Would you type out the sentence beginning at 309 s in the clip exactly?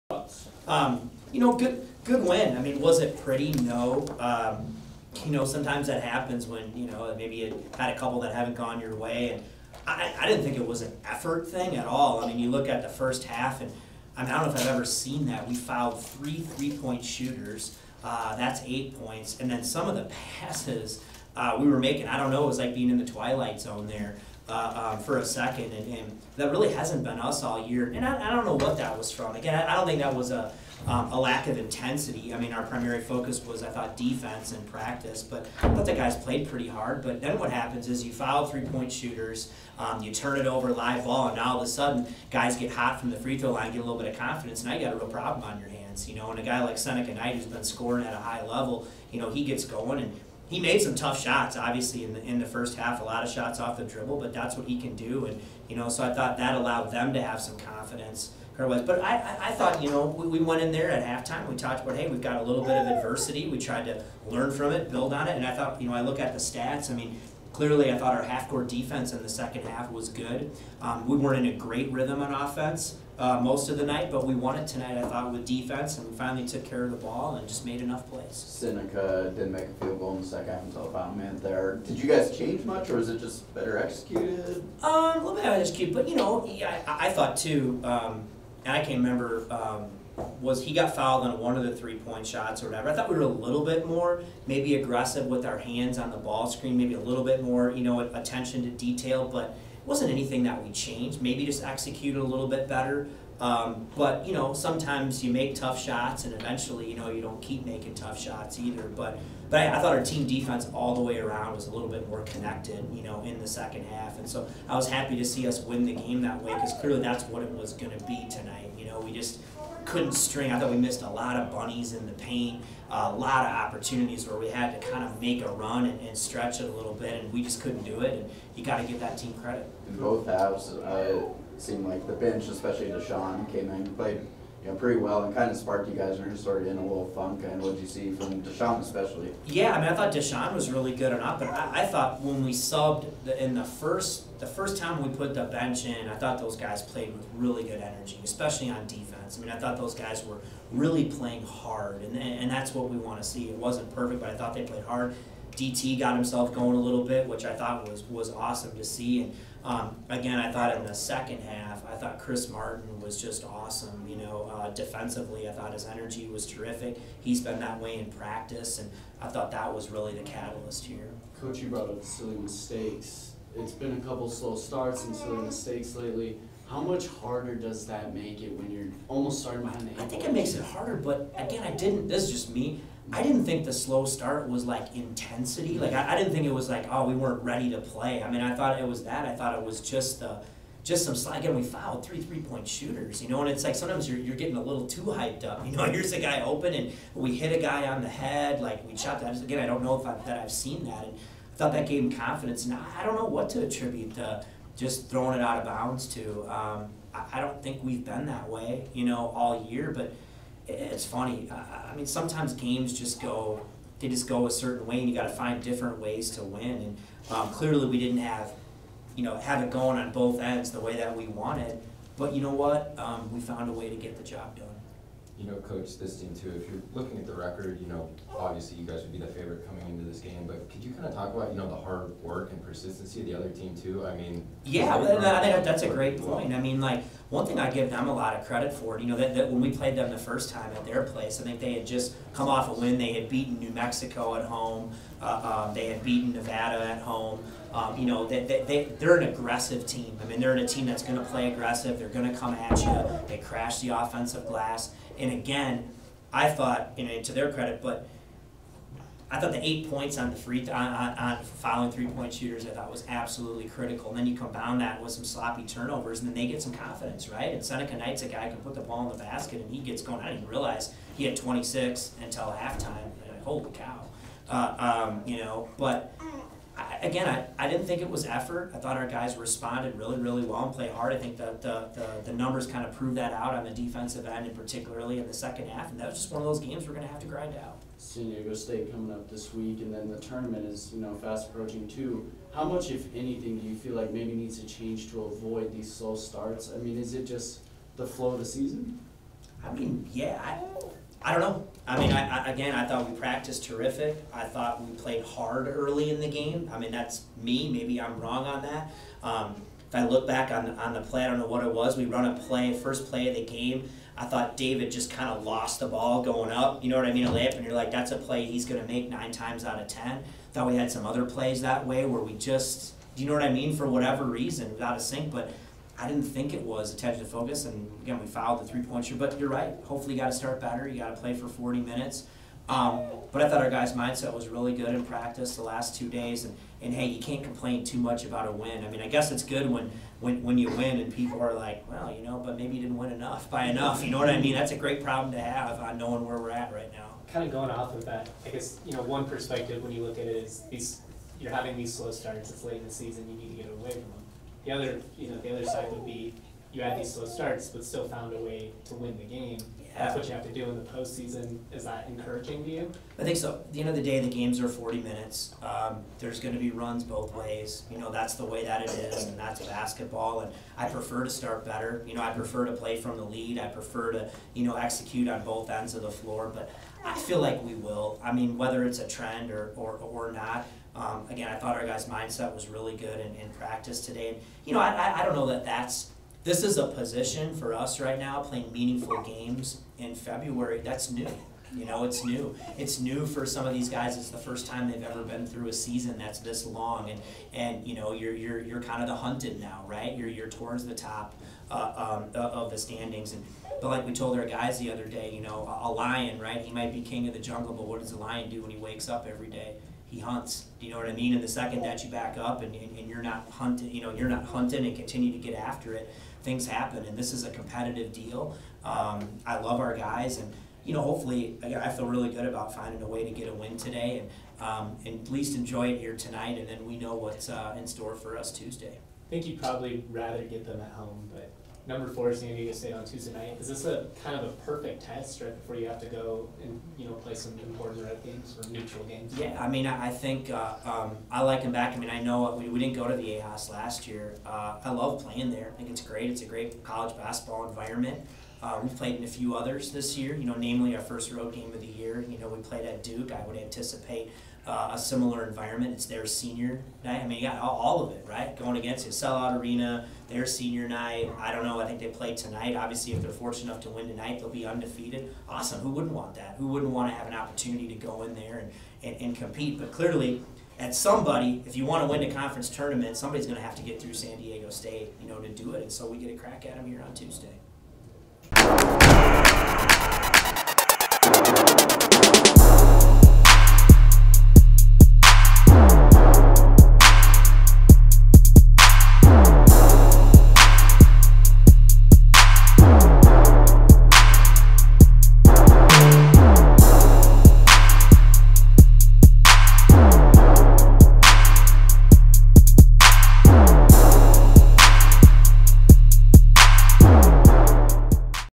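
Um, if I look back on, on the play, I don't know what it was.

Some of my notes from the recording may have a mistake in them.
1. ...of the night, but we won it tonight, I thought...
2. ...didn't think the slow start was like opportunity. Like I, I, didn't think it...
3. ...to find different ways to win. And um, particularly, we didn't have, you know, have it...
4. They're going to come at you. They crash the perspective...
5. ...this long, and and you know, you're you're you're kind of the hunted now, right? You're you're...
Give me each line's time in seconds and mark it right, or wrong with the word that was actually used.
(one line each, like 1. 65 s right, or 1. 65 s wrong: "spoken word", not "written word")
1. 73 s right
2. 183 s wrong: "intensity", not "opportunity"
3. 215 s wrong: "clearly", not "particularly"
4. 251 s wrong: "offensive", not "perspective"
5. 396 s right.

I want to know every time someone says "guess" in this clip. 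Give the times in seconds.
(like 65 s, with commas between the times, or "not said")
339 s, 348 s.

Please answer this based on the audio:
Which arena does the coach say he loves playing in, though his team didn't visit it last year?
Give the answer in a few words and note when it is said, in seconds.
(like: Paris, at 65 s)
Viejas, at 443 s.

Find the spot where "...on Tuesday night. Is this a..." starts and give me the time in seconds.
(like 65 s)
432 s.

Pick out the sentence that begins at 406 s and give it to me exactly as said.
He might be king of the jungle, but what does a lion do when he wakes up every day?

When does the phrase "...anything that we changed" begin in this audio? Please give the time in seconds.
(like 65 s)
100 s.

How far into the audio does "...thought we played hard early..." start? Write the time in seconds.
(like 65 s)
304 s.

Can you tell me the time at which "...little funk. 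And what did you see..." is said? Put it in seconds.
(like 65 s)
136 s.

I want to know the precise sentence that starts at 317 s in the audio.
A layup, and you're like, that's a play he's going to make nine times out of ten.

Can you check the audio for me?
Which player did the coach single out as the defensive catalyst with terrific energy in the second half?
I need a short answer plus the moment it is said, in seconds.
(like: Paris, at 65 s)
Kris Martin, at 162 s.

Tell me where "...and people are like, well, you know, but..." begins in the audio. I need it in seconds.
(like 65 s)
340 s.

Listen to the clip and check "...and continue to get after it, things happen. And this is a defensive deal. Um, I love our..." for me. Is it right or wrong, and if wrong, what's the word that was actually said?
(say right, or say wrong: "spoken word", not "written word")
wrong: "competitive", not "defensive".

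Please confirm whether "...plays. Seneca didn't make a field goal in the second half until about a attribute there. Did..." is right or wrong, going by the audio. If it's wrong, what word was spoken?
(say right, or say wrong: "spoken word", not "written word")
wrong: "minute", not "attribute".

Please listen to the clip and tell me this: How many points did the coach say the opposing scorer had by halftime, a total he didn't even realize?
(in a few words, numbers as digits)
26.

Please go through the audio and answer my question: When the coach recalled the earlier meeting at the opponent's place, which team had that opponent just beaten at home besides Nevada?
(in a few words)
New Mexico.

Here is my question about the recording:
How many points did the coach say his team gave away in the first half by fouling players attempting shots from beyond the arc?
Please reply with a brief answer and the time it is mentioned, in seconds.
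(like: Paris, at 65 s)
8, at 18 s.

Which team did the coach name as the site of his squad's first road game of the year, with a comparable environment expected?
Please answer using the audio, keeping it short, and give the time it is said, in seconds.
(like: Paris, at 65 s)
Duke, at 453 s.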